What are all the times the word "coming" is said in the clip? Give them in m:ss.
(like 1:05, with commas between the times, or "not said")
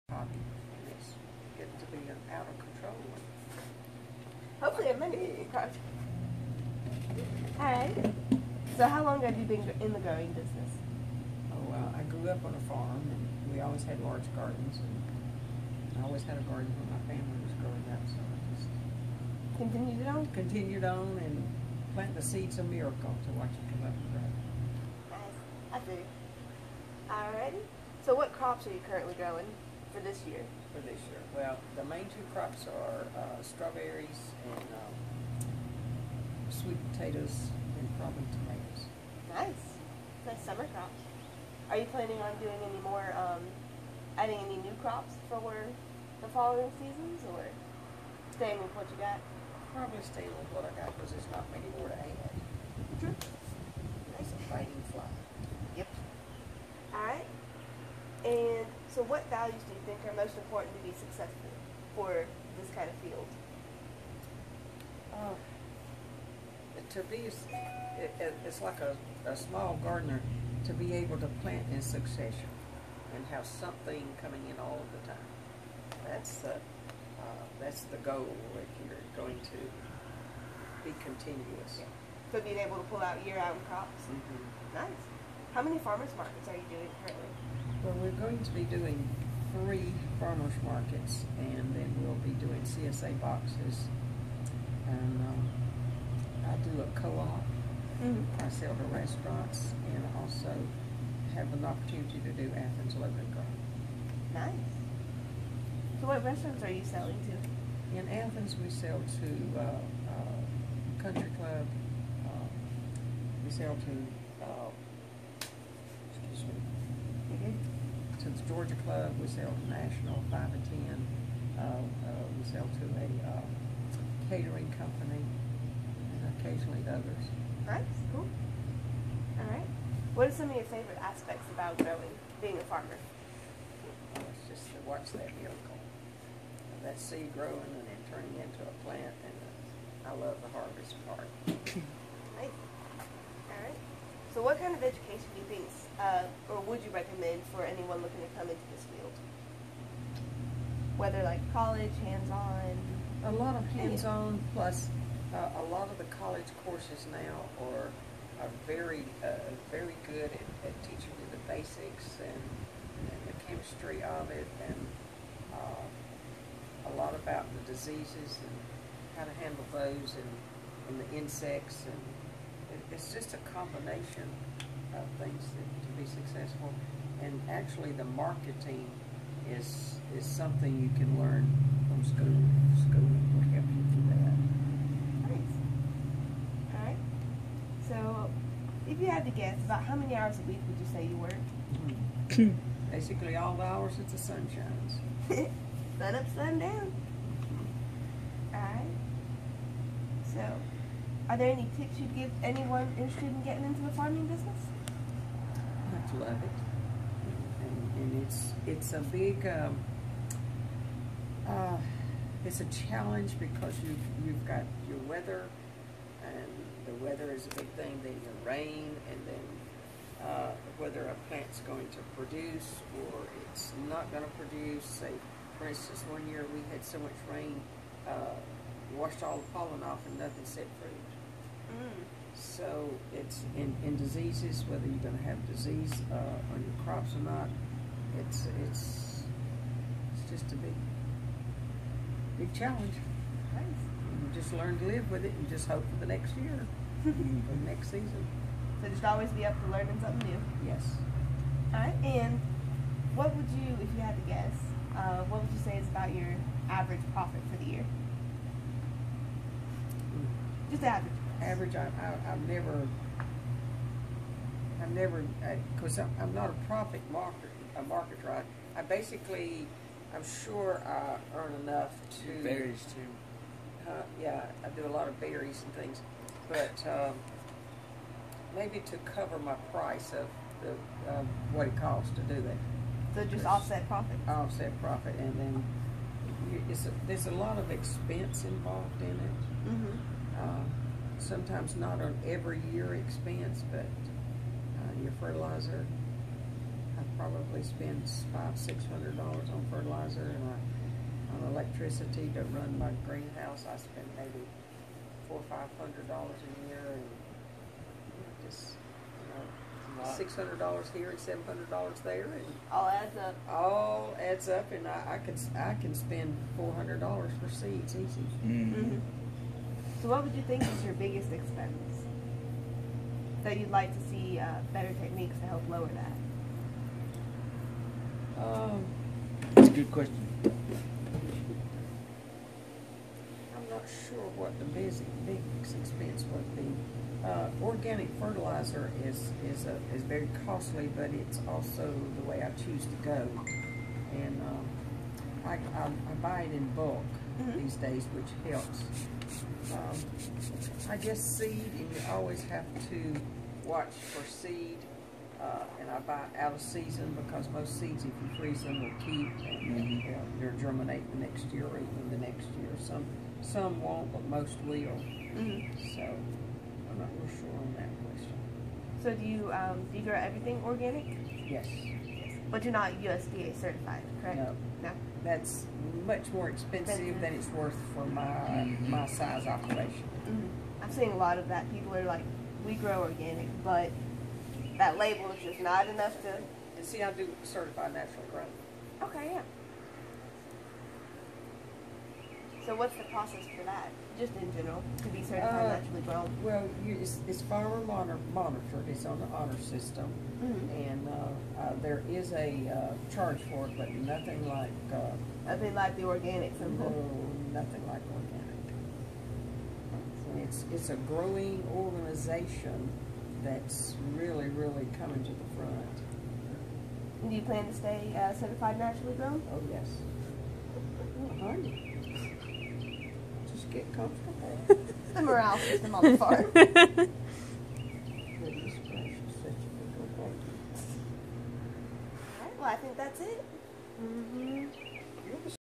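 1:14, 6:54.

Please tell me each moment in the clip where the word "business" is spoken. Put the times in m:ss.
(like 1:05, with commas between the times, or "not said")
0:10, 3:24.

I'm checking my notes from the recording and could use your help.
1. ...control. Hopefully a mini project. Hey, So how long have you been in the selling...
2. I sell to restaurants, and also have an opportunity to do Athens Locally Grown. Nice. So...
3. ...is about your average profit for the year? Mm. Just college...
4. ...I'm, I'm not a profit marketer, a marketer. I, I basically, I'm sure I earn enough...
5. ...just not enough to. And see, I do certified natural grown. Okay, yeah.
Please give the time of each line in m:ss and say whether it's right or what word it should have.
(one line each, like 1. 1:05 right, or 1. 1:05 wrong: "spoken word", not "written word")
1. 0:02 wrong: "growing", not "selling"
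2. 1:38 right
3. 4:15 wrong: "average", not "college"
4. 4:26 right
5. 6:25 right.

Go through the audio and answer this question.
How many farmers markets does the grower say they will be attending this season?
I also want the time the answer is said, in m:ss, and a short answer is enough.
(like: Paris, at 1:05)
3, at 1:29.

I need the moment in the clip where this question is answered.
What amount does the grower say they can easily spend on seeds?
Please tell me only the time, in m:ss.
5:16.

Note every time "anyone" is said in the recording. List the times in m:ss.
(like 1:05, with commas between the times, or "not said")
2:27, 3:22.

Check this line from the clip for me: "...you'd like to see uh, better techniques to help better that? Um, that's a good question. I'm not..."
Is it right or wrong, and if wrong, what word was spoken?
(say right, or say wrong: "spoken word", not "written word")
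wrong: "lower", not "better".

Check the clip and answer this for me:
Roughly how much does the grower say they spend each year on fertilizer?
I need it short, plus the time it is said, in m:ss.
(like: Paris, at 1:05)
$500-600, at 4:58.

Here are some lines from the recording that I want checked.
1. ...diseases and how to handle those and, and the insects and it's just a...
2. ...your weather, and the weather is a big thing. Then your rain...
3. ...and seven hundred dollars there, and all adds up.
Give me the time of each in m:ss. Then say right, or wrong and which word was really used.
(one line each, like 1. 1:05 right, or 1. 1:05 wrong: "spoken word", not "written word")
1. 2:47 right
2. 3:34 right
3. 5:11 right.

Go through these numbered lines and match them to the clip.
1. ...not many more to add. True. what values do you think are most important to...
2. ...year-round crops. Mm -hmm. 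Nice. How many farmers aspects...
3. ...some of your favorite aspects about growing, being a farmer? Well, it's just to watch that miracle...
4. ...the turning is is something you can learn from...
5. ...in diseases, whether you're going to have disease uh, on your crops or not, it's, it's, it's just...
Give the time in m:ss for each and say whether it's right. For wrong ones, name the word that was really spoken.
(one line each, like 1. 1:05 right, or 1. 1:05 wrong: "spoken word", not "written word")
1. 0:51 right
2. 1:23 wrong: "markets", not "aspects"
3. 2:10 right
4. 2:57 wrong: "marketing", not "turning"
5. 3:53 right.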